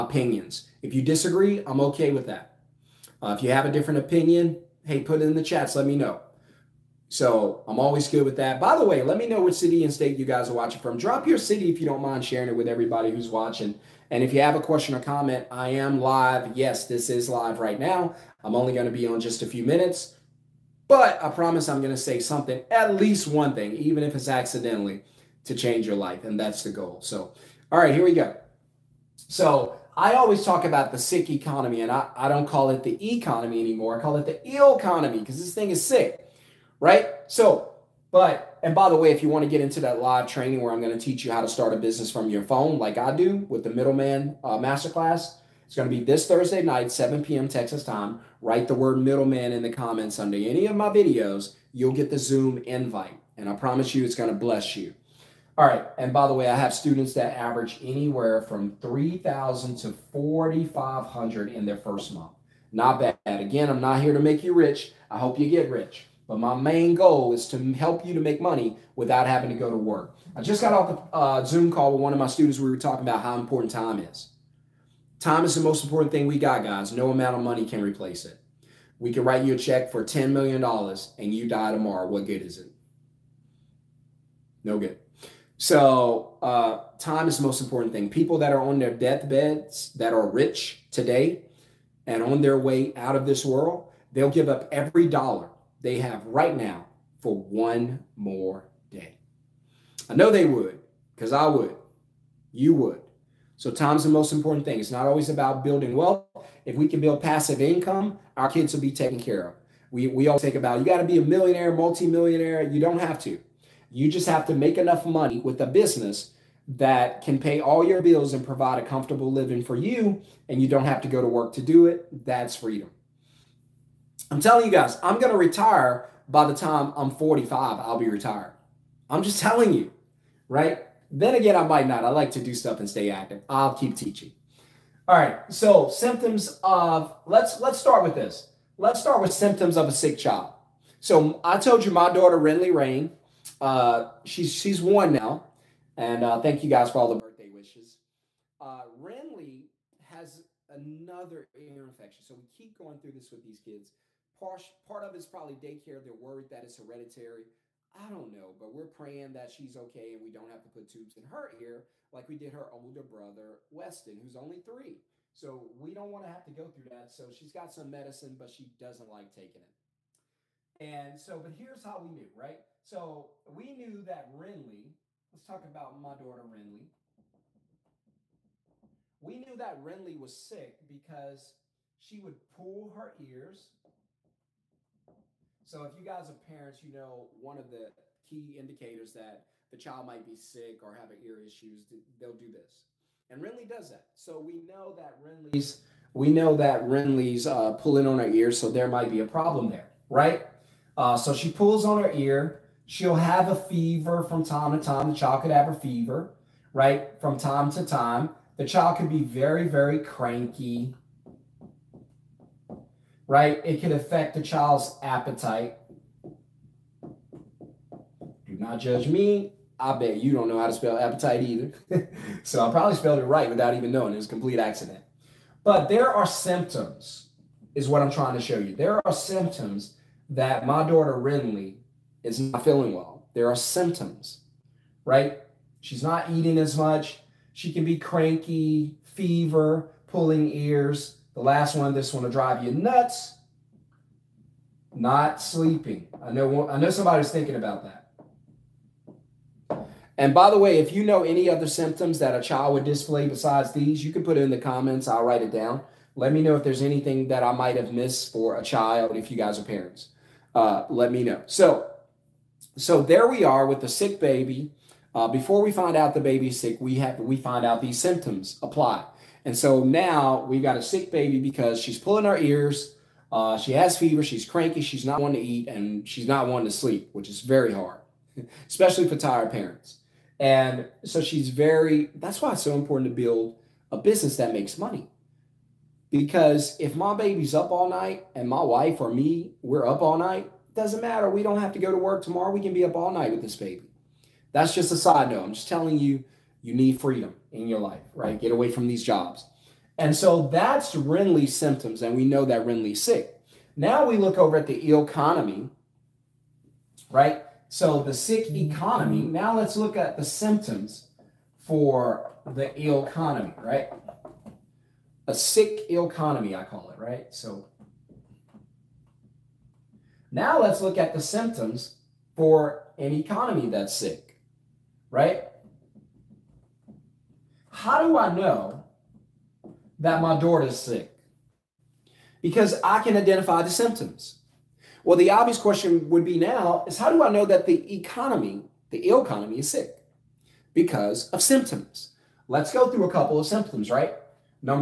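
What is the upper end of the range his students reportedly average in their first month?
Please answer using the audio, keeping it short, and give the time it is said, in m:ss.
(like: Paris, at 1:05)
4,500, at 1:00.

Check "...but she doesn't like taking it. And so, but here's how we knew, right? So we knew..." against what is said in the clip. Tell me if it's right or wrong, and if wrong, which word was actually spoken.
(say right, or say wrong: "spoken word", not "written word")
right.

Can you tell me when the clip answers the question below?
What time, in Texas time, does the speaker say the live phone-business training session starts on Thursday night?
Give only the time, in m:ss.
0:46.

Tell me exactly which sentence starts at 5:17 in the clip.
So now let's look at the symptoms for an economy that's sick, right?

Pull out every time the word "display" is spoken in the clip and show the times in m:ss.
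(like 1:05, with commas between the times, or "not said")
4:12.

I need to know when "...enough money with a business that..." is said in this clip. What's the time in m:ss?
1:54.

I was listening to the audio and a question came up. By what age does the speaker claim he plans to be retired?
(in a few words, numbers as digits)
45.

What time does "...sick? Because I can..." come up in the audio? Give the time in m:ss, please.
5:30.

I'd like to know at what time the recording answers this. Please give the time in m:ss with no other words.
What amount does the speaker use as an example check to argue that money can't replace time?
1:20.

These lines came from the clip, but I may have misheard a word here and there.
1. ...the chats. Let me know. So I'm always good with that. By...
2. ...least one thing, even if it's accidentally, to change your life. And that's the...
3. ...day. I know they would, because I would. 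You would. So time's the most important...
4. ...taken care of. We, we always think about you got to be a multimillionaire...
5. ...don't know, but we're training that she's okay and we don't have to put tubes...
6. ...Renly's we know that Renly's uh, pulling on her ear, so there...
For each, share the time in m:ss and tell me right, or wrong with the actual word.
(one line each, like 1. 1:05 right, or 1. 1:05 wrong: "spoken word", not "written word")
1. 0:05 right
2. 0:22 right
3. 1:38 right
4. 1:48 wrong: "millionaire", not "multimillionaire"
5. 2:38 wrong: "praying", not "training"
6. 3:15 right.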